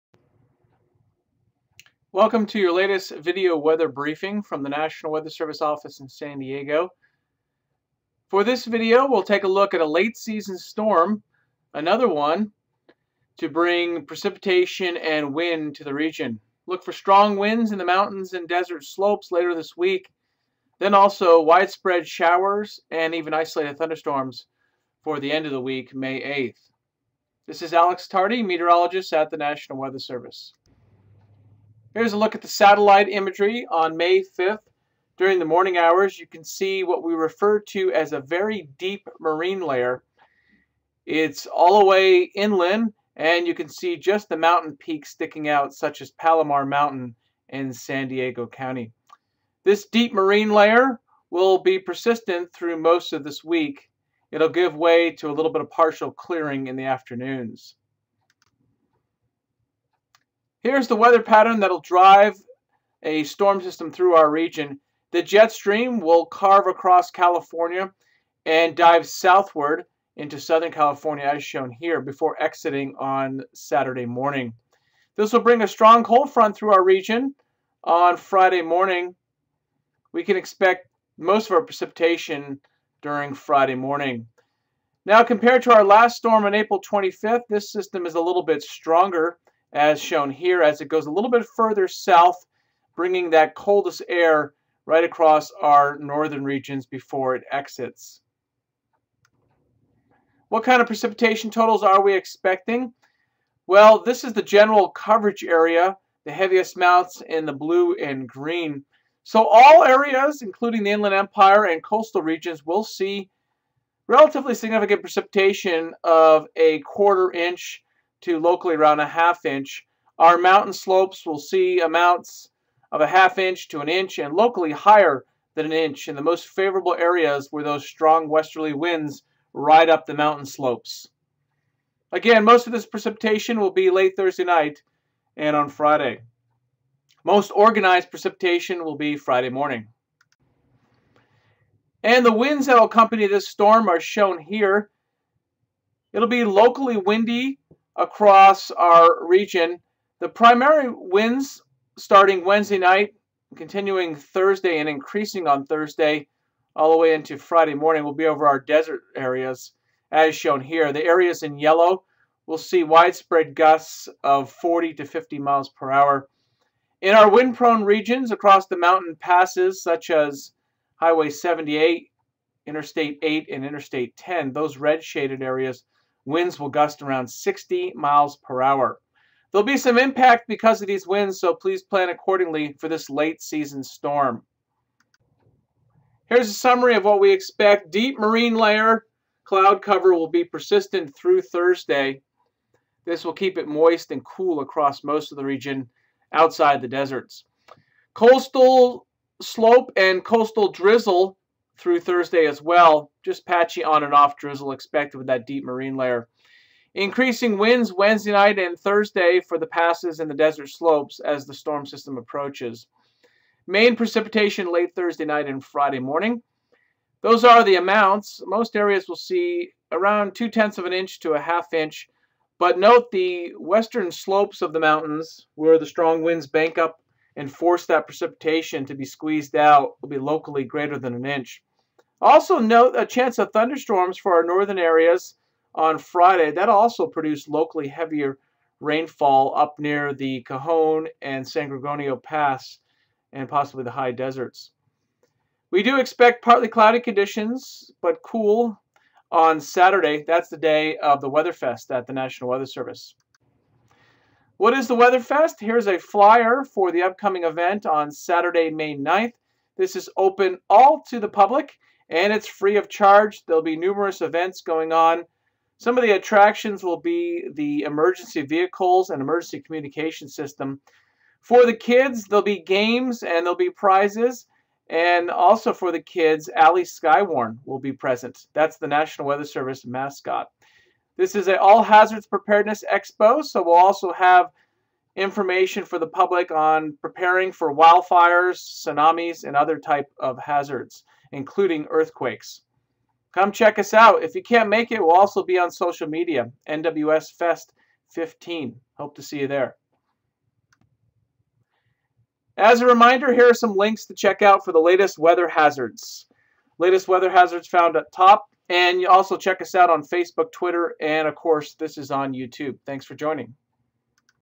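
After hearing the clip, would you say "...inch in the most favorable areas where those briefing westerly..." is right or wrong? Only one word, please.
wrong.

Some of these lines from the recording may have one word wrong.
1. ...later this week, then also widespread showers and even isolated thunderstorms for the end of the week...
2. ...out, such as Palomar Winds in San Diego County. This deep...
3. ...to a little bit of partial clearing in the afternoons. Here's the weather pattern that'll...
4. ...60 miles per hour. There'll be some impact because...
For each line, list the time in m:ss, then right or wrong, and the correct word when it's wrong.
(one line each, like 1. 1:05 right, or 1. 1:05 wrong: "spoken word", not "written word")
1. 0:19 right
2. 0:45 wrong: "Mountain", not "Winds"
3. 0:55 right
4. 2:57 right.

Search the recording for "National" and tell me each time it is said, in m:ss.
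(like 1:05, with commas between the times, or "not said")
0:04, 0:29, 4:12, 4:38.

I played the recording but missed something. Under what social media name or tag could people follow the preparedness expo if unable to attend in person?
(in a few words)
NWS Fest 15.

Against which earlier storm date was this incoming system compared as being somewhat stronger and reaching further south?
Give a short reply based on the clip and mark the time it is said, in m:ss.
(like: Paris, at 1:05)
April 25th, at 1:26.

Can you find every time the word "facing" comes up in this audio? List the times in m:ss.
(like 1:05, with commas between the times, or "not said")
not said.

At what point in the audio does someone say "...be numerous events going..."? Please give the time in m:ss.
4:23.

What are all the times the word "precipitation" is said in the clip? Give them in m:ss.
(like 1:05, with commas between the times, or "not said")
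0:14, 1:21, 1:40, 1:54, 2:12, 2:18, 3:33, 3:48.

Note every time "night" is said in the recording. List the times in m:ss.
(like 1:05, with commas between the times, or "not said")
2:14, 2:32, 3:28, 3:35.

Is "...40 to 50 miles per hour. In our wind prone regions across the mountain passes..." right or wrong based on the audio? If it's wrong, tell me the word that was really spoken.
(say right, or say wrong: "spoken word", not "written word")
right.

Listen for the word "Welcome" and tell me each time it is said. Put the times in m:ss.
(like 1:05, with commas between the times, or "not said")
0:02.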